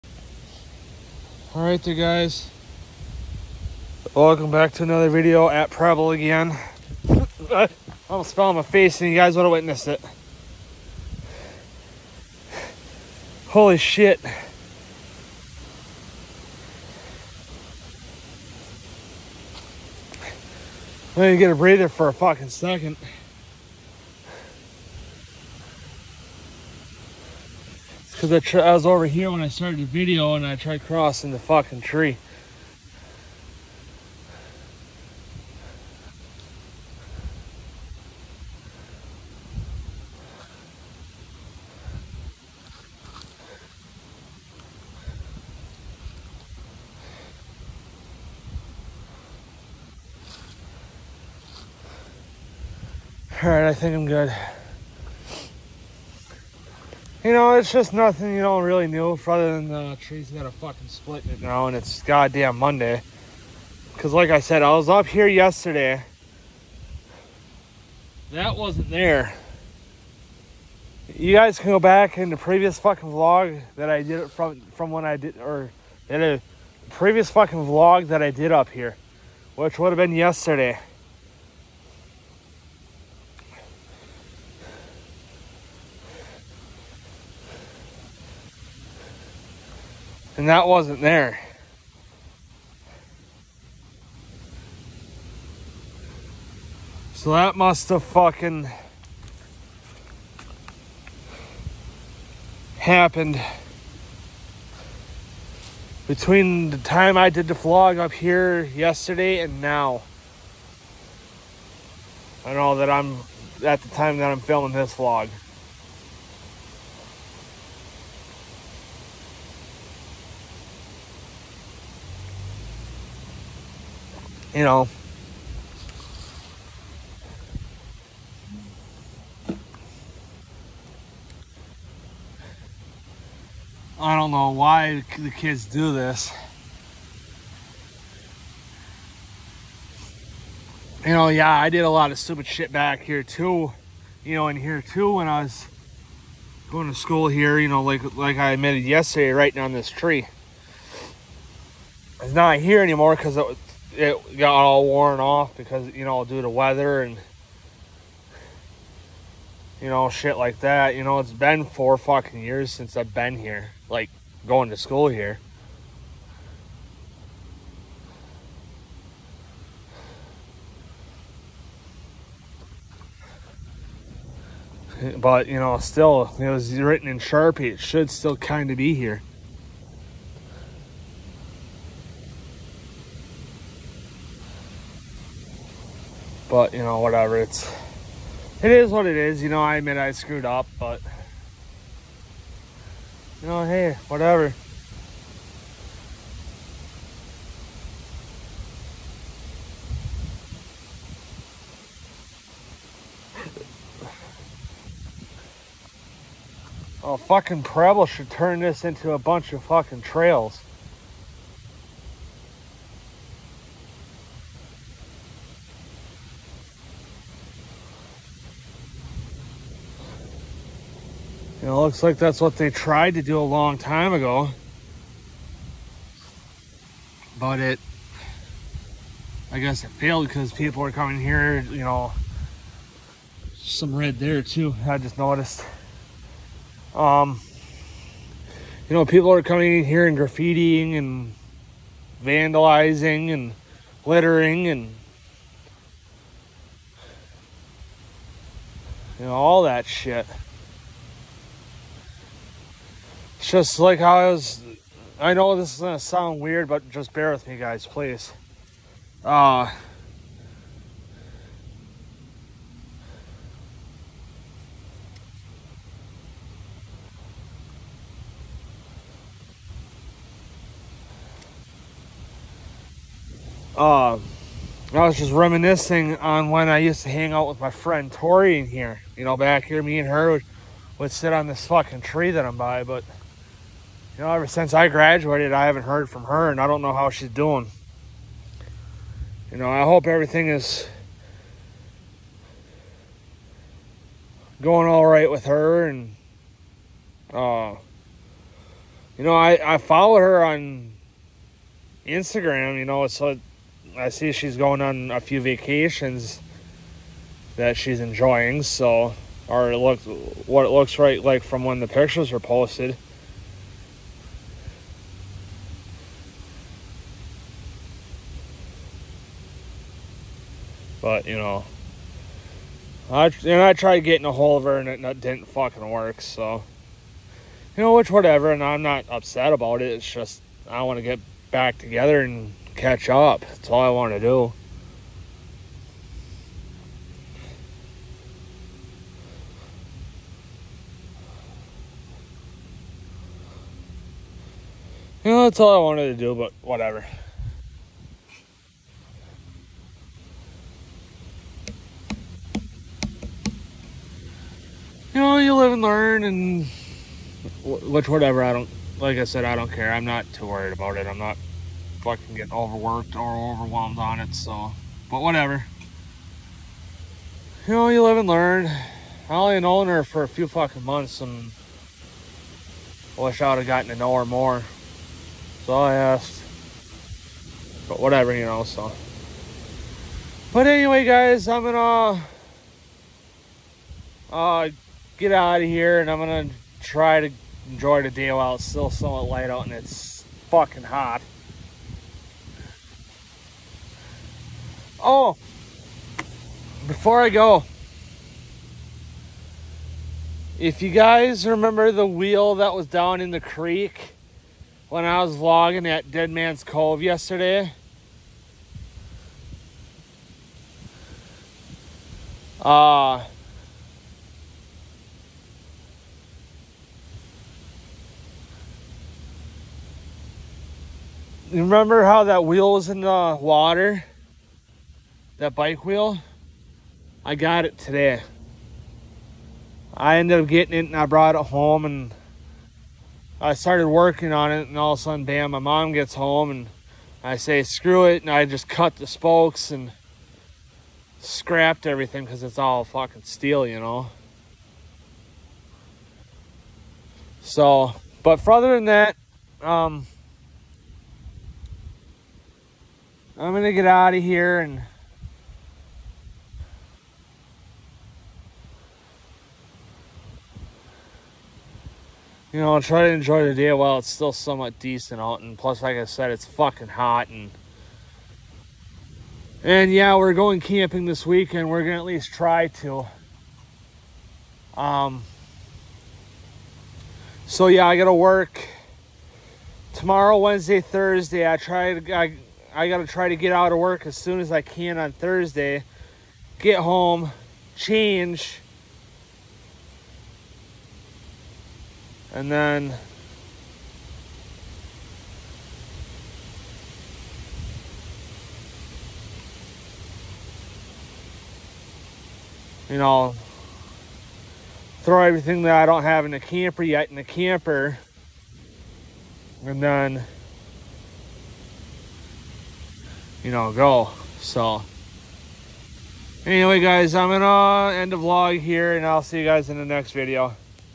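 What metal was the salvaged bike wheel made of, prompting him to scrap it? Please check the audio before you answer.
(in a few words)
Steel.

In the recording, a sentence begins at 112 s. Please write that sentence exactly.
I know that I'm at the time that I'm filming this vlog.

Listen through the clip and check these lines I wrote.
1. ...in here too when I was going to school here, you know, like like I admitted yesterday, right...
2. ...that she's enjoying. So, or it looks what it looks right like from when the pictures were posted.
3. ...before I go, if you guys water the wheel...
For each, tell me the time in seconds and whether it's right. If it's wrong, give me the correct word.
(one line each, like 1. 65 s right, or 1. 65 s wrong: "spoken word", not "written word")
1. 144 s right
2. 307 s right
3. 396 s wrong: "remember", not "water".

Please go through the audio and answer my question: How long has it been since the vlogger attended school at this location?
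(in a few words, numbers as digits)
4 years.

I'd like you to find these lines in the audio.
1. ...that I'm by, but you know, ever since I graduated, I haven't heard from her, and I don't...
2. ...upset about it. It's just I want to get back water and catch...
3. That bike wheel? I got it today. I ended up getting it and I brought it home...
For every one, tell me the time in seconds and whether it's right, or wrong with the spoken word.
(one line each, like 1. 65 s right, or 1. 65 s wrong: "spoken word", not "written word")
1. 282 s right
2. 329 s wrong: "together", not "water"
3. 425 s right.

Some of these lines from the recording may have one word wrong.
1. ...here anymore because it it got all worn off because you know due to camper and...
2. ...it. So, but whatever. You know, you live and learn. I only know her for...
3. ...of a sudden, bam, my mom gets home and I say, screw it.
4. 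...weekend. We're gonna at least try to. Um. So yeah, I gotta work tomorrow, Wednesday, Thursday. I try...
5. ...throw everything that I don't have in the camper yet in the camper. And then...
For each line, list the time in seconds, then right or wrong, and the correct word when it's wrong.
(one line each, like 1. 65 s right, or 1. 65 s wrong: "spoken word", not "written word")
1. 152 s wrong: "weather", not "camper"
2. 364 s right
3. 434 s right
4. 471 s right
5. 505 s right.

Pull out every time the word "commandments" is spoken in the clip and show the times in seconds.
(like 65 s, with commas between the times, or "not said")
not said.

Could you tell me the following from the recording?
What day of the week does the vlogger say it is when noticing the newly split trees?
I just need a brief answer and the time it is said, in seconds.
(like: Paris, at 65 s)
Monday, at 62 s.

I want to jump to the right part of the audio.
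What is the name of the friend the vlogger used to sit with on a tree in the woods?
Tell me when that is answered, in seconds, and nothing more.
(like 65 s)
278 s.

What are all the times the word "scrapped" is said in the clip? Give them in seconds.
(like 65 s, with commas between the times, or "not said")
441 s.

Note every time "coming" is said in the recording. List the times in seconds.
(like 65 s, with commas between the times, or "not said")
230 s, 239 s.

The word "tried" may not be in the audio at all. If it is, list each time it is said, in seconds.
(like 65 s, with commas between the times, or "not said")
30 s, 222 s, 323 s.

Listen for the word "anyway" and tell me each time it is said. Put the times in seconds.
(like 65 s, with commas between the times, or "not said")
380 s, 516 s.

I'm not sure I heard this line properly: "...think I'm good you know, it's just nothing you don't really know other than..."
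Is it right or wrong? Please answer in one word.
right.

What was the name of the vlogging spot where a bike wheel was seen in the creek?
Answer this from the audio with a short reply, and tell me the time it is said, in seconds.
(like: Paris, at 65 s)
Dead Man's Cove, at 406 s.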